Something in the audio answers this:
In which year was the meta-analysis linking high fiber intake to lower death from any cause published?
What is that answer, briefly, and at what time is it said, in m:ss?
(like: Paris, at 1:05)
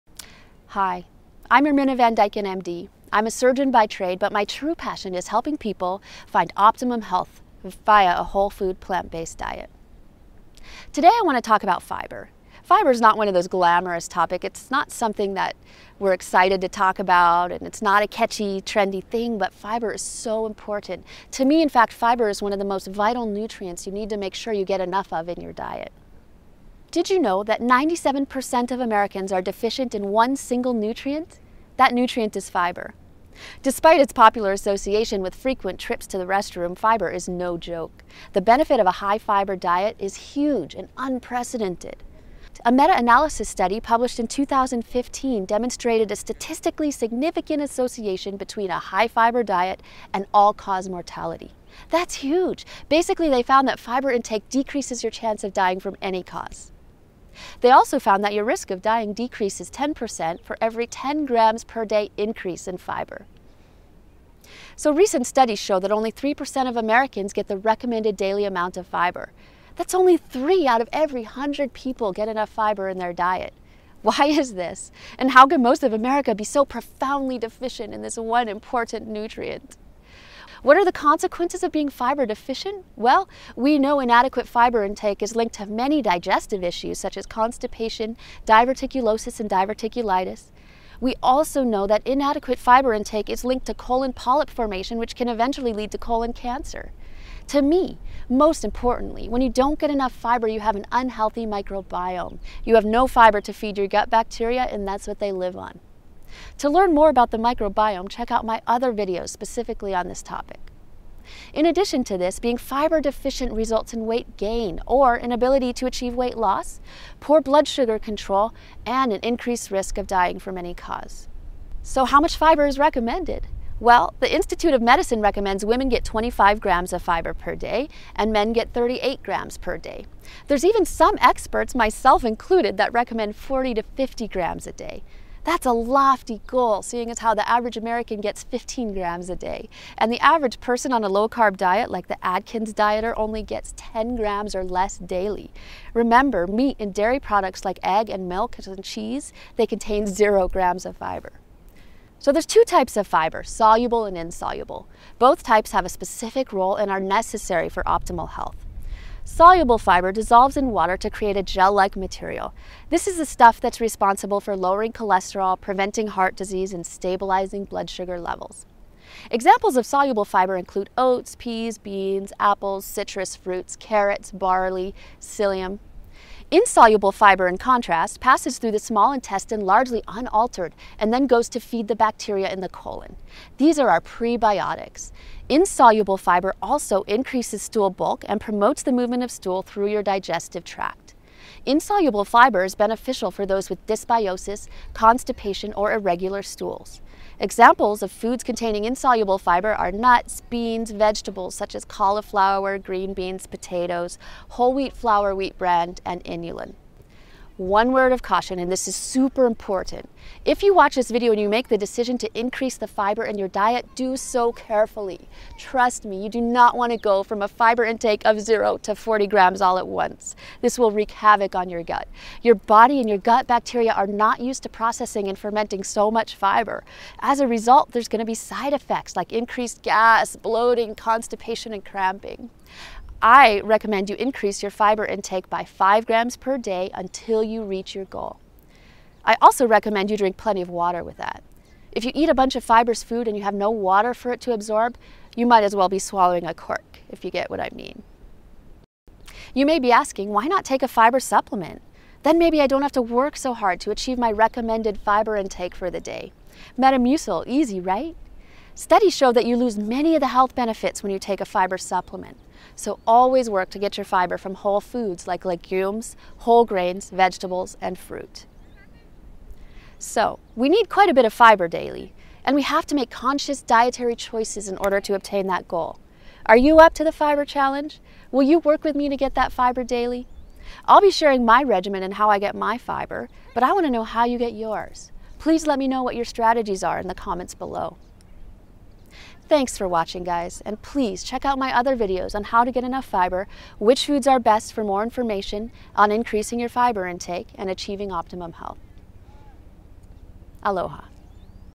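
2015, at 0:44.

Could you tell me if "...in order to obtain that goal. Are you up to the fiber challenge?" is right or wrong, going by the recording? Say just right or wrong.
right.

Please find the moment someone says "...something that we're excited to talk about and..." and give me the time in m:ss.
0:14.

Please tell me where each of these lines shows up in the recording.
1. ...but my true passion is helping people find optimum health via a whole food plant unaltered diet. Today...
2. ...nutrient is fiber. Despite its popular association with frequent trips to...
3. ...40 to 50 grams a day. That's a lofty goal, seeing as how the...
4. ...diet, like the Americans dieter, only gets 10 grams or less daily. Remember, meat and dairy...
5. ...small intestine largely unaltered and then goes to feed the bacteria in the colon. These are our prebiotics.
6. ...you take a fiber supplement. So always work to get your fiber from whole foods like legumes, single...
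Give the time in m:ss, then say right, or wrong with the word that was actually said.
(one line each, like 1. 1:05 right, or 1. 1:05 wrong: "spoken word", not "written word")
1. 0:04 wrong: "based", not "unaltered"
2. 0:31 right
3. 2:13 right
4. 2:21 wrong: "Atkins", not "Americans"
5. 2:58 right
6. 4:21 wrong: "whole", not "single".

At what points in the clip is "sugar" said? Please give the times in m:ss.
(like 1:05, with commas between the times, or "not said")
1:57, 2:47.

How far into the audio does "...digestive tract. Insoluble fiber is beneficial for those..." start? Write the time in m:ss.
3:10.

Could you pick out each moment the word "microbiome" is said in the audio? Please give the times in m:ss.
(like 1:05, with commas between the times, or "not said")
1:41, 1:47.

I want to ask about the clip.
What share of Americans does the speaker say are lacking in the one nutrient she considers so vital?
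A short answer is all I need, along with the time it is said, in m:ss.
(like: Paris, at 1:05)
97%, at 0:27.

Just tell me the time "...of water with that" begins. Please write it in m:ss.
4:00.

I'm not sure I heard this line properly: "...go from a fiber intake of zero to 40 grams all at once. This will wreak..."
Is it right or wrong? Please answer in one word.
right.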